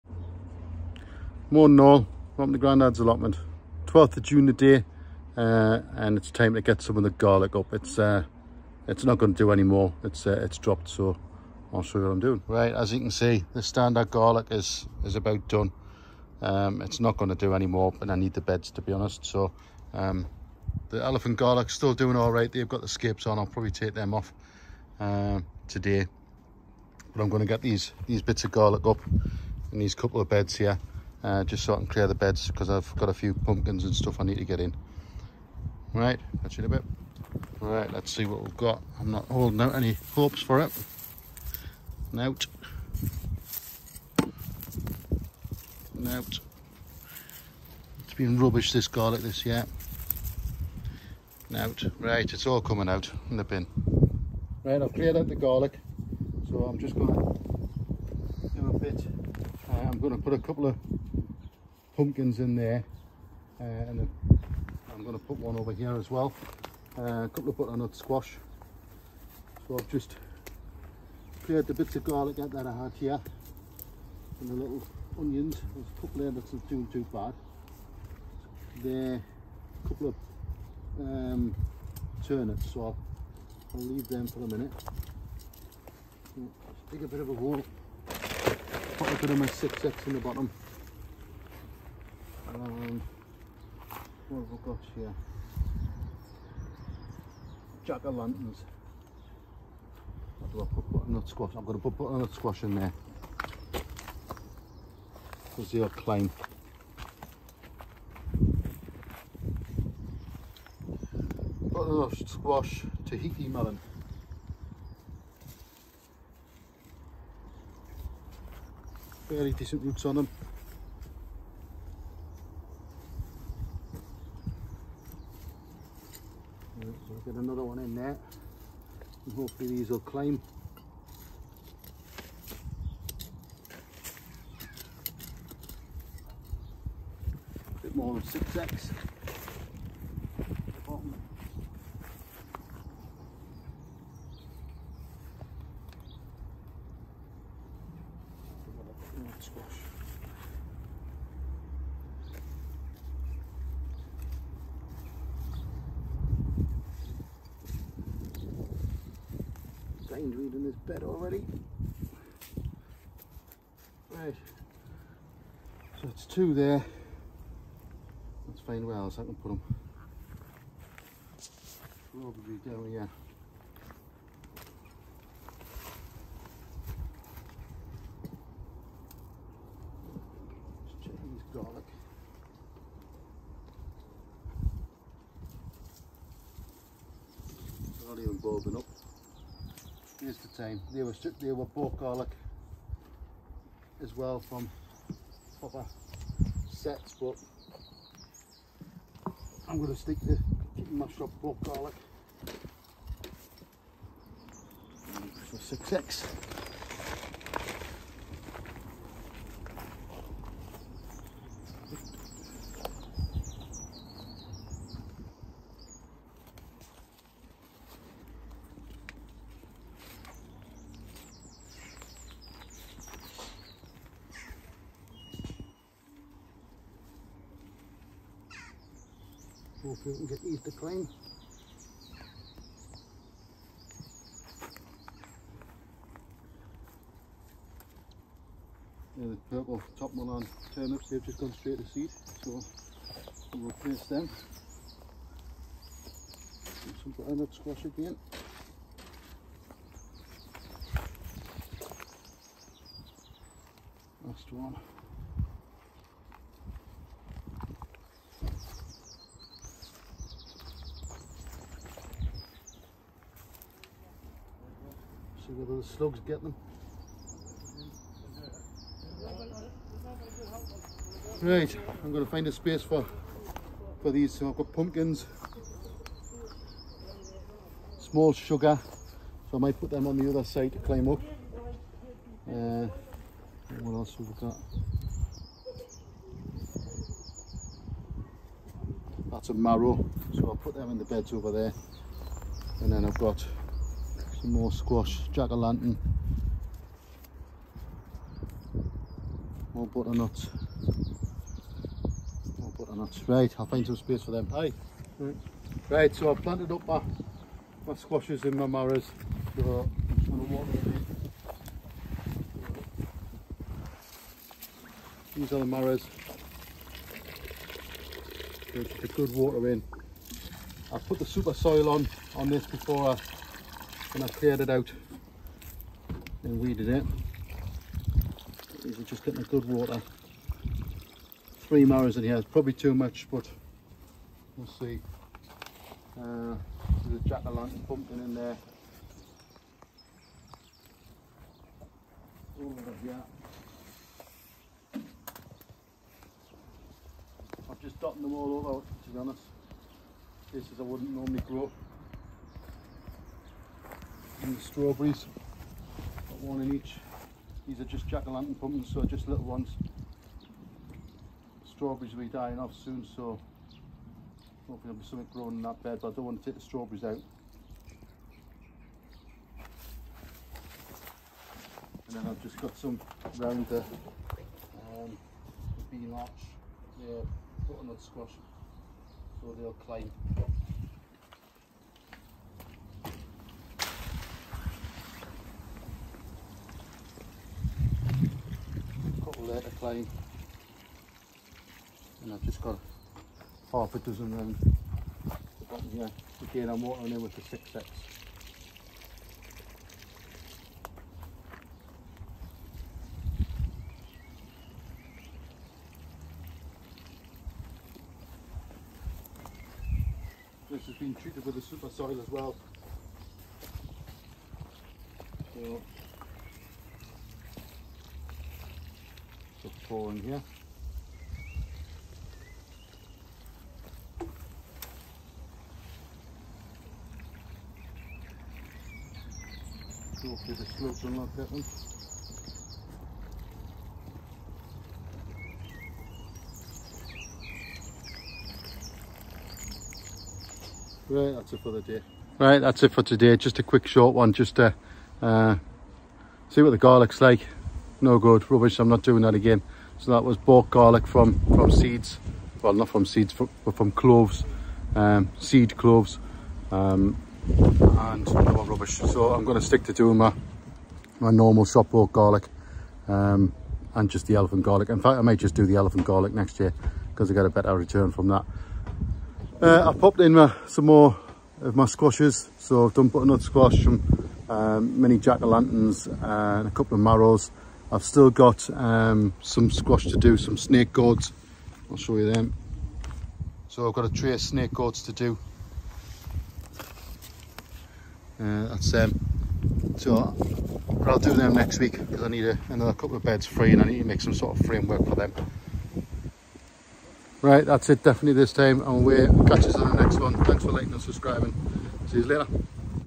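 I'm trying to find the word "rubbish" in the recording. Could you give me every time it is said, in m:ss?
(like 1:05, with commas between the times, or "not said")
0:48, 7:28, 7:38.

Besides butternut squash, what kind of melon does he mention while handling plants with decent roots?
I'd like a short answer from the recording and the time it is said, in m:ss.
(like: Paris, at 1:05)
Tahiti melon, at 1:53.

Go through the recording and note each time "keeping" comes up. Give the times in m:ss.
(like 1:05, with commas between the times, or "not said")
3:20.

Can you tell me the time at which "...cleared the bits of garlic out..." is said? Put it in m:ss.
1:11.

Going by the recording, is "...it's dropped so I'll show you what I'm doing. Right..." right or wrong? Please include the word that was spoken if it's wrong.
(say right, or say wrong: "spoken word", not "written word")
right.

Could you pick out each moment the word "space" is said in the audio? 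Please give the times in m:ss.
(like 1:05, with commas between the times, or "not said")
4:32, 5:03.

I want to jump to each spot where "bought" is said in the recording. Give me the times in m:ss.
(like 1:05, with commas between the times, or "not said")
7:30, 7:41.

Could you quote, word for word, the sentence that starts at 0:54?
Right, I've cleared out the garlic.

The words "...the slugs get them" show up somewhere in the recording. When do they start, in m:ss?
4:25.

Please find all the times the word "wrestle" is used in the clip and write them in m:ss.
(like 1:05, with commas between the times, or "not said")
not said.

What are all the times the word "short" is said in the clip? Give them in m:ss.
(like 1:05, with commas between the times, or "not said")
7:23.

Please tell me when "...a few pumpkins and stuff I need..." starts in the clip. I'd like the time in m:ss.
0:33.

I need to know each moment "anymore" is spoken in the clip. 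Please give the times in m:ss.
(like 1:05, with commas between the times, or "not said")
0:09, 0:17.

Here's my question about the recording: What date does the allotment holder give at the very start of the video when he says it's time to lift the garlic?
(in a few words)
12th of June.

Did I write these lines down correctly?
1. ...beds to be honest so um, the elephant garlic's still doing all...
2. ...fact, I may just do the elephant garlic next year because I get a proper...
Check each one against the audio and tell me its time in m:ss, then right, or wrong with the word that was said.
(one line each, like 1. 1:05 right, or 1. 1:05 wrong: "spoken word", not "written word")
1. 0:18 right
2. 7:45 wrong: "better", not "proper".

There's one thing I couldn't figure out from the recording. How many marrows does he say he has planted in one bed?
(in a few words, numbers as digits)
3.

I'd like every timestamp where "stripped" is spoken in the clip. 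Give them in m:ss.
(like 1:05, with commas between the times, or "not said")
3:11.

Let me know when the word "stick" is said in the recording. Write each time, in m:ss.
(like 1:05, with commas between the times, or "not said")
3:19, 7:39.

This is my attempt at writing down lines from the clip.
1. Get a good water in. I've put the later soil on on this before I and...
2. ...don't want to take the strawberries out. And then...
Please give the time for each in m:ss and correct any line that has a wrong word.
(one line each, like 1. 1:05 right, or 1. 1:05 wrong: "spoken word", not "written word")
1. 5:18 wrong: "super", not "later"
2. 6:06 right.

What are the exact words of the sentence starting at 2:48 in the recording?
Let's find where else I can put them.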